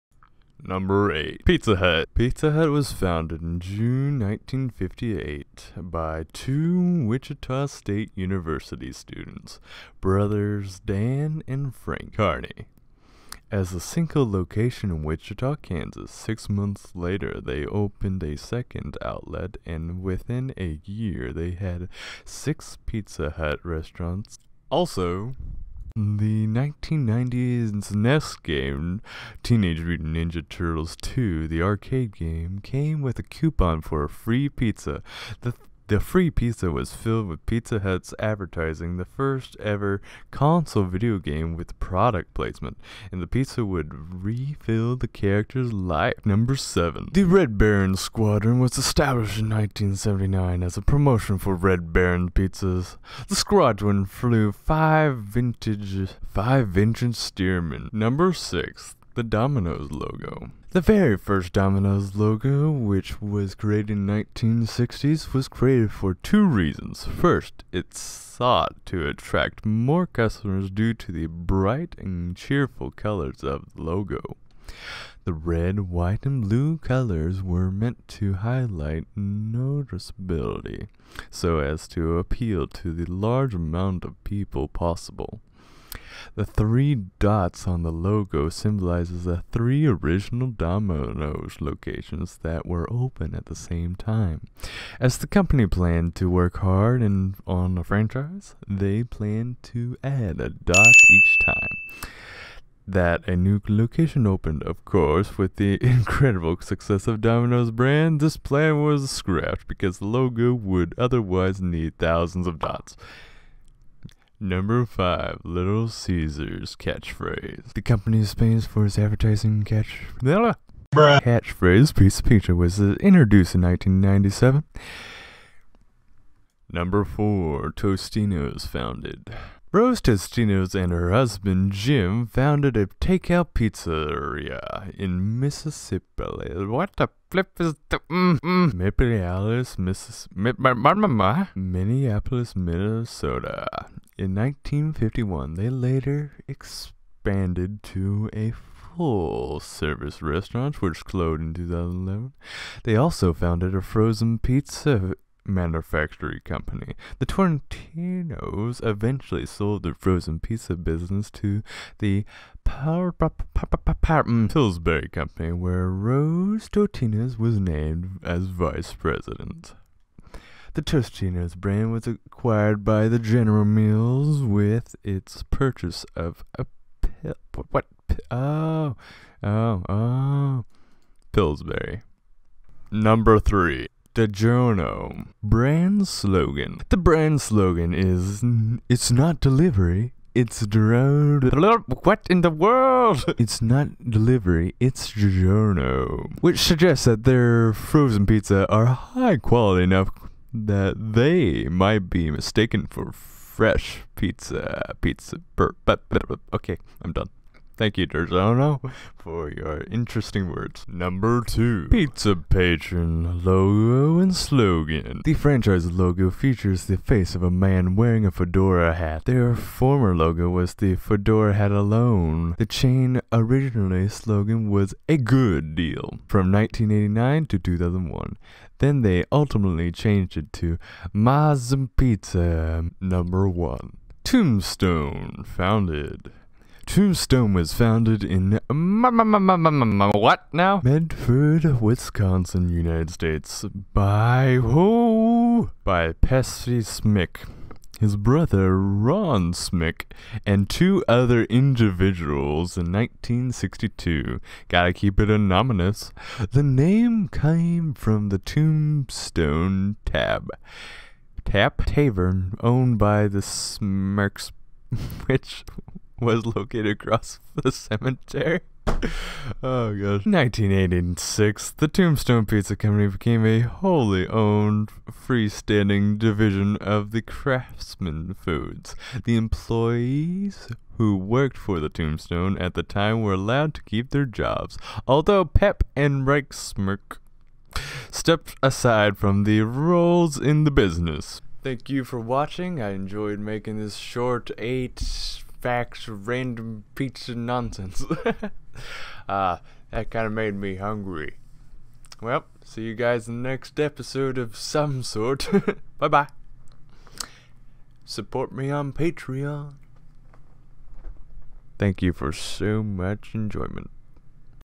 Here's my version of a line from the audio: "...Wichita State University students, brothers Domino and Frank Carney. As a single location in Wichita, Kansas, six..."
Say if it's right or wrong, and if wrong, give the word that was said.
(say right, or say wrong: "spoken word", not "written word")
wrong: "Dan", not "Domino".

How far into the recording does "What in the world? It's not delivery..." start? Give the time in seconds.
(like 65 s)
192 s.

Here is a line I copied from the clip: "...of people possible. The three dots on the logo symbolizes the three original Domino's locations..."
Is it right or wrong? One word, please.
right.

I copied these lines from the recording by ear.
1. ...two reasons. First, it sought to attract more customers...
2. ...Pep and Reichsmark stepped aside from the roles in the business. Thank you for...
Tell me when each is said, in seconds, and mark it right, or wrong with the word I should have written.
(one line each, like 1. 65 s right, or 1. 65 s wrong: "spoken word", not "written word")
1. 66 s right
2. 285 s right.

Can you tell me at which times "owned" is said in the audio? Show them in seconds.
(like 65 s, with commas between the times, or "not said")
262 s, 274 s.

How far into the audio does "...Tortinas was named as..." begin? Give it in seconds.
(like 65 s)
166 s.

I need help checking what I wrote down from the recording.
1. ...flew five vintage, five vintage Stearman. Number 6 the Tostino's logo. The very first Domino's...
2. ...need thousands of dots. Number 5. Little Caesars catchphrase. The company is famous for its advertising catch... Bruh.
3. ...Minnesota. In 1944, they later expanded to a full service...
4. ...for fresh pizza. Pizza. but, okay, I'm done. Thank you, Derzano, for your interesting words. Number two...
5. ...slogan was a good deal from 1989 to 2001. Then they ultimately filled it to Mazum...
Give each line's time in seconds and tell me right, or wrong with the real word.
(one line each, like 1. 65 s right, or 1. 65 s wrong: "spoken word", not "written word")
1. 54 s wrong: "Domino", not "Tostino"
2. 111 s right
3. 142 s wrong: "1951", not "1944"
4. 202 s right
5. 224 s wrong: "changed", not "filled".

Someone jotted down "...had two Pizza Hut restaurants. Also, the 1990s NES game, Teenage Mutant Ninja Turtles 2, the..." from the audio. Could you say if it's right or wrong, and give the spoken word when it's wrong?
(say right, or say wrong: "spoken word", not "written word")
wrong: "six", not "two".